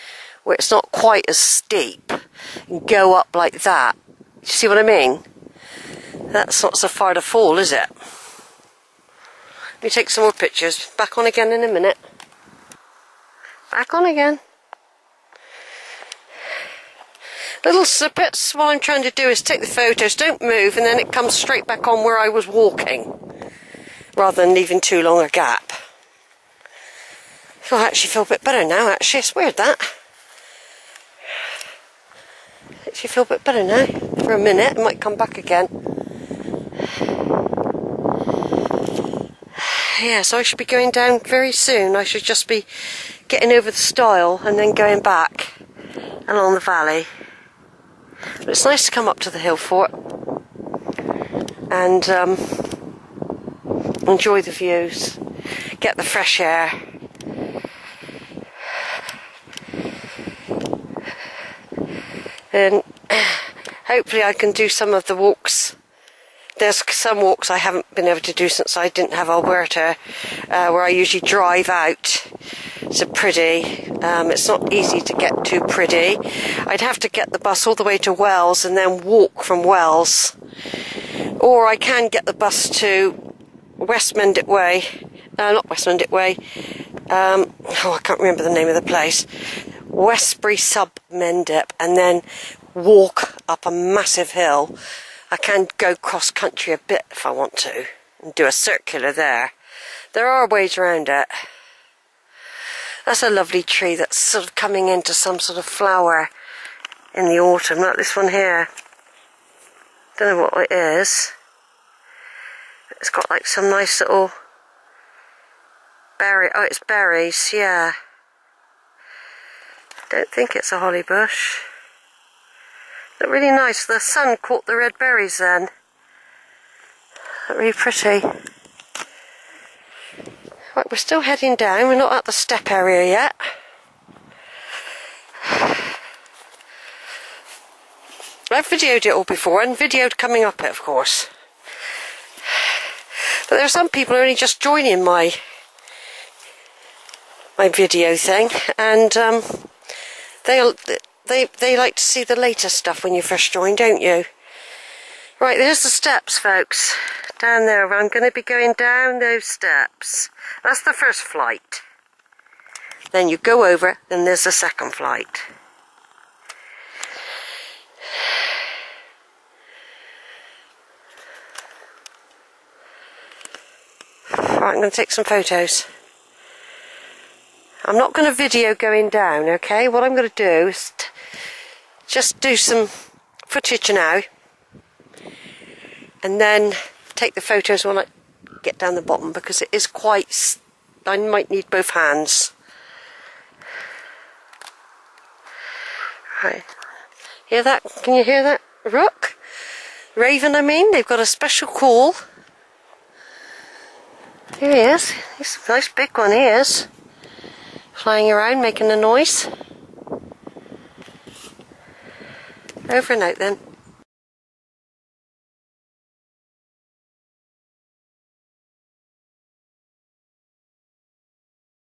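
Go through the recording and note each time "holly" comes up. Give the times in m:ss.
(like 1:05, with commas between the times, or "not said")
2:00.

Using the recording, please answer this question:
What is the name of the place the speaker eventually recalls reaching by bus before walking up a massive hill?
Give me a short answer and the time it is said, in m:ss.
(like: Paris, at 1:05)
Westbury Sub Mendip, at 1:29.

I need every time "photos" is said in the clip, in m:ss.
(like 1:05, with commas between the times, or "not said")
0:19, 2:55, 3:07.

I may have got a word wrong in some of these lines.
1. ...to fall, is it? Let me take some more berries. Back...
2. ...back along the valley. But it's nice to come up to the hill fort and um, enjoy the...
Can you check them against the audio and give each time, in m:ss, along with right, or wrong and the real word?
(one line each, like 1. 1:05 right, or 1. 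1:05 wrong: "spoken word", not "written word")
1. 0:07 wrong: "pictures", not "berries"
2. 0:45 right.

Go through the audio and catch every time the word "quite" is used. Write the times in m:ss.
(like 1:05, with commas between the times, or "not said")
0:00, 3:09.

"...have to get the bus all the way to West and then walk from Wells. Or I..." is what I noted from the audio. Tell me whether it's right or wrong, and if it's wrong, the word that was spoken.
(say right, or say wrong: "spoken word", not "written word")
wrong: "Wells", not "West".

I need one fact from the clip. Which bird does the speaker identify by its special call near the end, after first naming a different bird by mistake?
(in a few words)
Raven.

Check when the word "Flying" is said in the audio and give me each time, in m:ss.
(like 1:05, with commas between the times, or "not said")
3:27.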